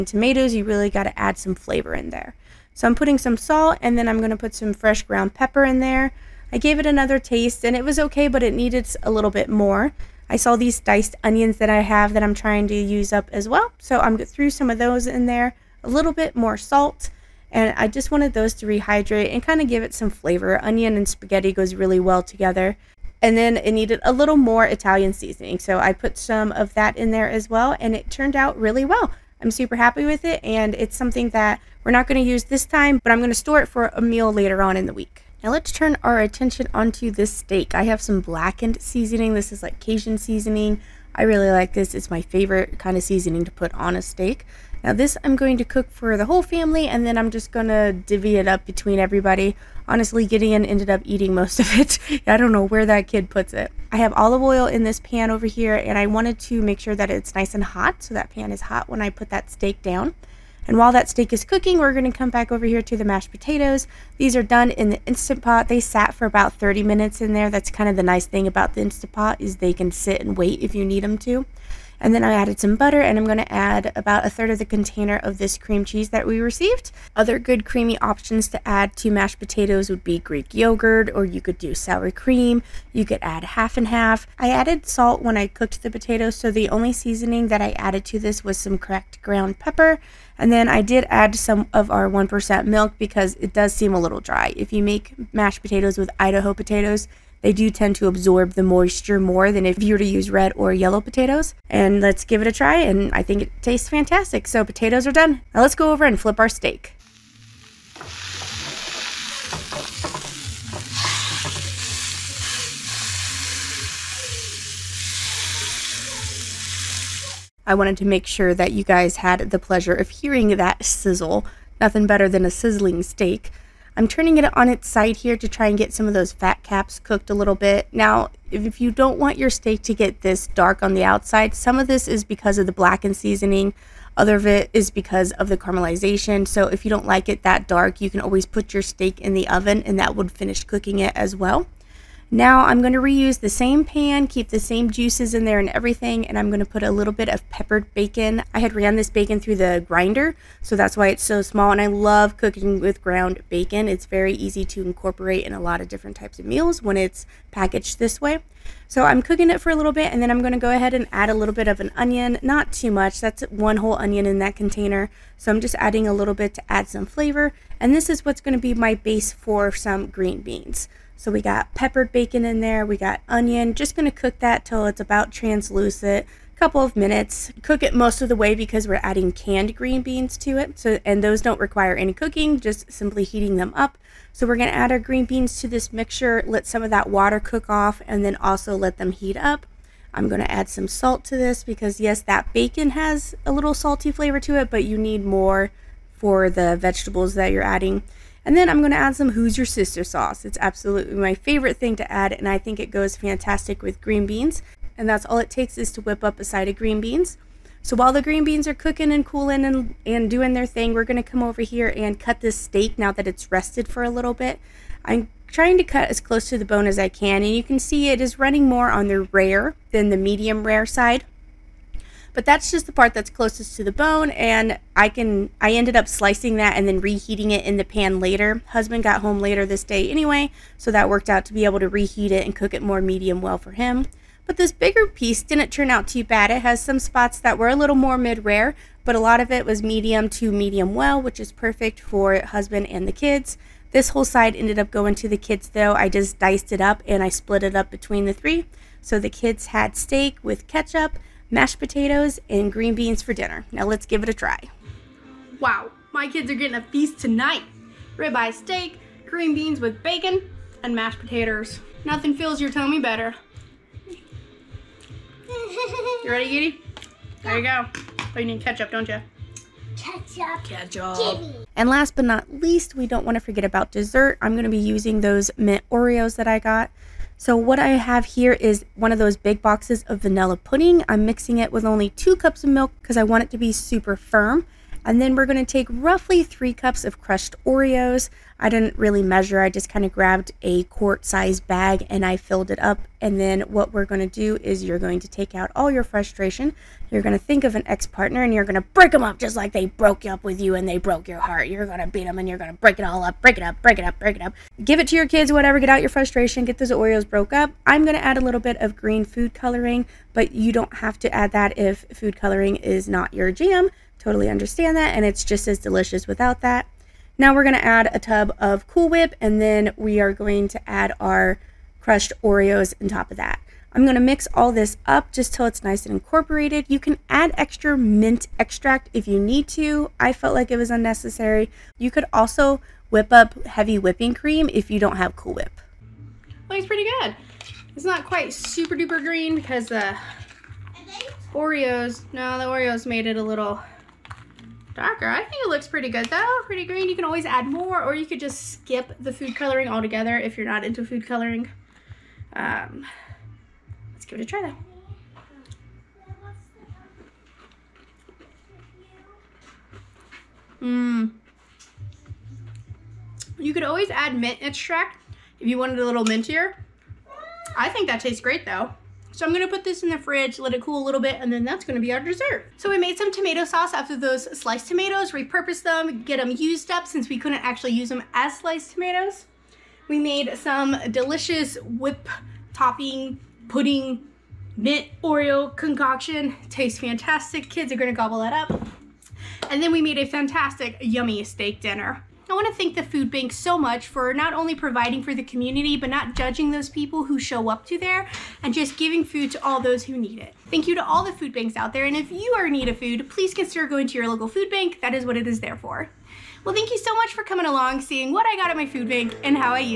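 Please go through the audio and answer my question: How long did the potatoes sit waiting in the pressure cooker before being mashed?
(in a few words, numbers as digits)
30 minutes.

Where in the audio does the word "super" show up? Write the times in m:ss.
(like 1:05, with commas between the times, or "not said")
0:29, 4:43, 5:38.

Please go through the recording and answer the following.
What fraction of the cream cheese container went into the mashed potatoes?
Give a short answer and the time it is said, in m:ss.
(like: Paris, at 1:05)
A third, at 1:14.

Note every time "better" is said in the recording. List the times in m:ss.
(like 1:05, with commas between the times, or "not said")
2:02, 4:22.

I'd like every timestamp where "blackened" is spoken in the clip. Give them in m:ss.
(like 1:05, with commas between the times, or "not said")
0:38, 2:12.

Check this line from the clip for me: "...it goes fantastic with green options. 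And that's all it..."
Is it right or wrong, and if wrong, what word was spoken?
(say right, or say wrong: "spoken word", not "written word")
wrong: "beans", not "options".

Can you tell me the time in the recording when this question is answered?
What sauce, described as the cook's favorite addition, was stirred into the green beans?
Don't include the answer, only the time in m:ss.
3:19.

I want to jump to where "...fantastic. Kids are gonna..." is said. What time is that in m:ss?
6:26.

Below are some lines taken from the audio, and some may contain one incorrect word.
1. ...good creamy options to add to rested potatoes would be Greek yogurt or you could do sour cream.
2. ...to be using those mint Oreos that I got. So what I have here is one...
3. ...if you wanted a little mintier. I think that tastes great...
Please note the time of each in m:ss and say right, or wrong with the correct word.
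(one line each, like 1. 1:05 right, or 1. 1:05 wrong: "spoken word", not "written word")
1. 1:17 wrong: "mashed", not "rested"
2. 4:34 right
3. 6:05 right.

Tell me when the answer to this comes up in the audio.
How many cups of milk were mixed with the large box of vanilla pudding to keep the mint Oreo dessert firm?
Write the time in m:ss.
4:42.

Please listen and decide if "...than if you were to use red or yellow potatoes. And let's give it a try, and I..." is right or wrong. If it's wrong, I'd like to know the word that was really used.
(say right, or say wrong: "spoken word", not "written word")
right.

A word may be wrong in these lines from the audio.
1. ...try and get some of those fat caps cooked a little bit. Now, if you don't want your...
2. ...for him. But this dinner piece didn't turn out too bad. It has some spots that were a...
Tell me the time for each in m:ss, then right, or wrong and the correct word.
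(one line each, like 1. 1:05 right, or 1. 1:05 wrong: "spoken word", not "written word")
1. 2:05 right
2. 3:53 wrong: "bigger", not "dinner".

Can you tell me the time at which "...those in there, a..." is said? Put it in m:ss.
0:14.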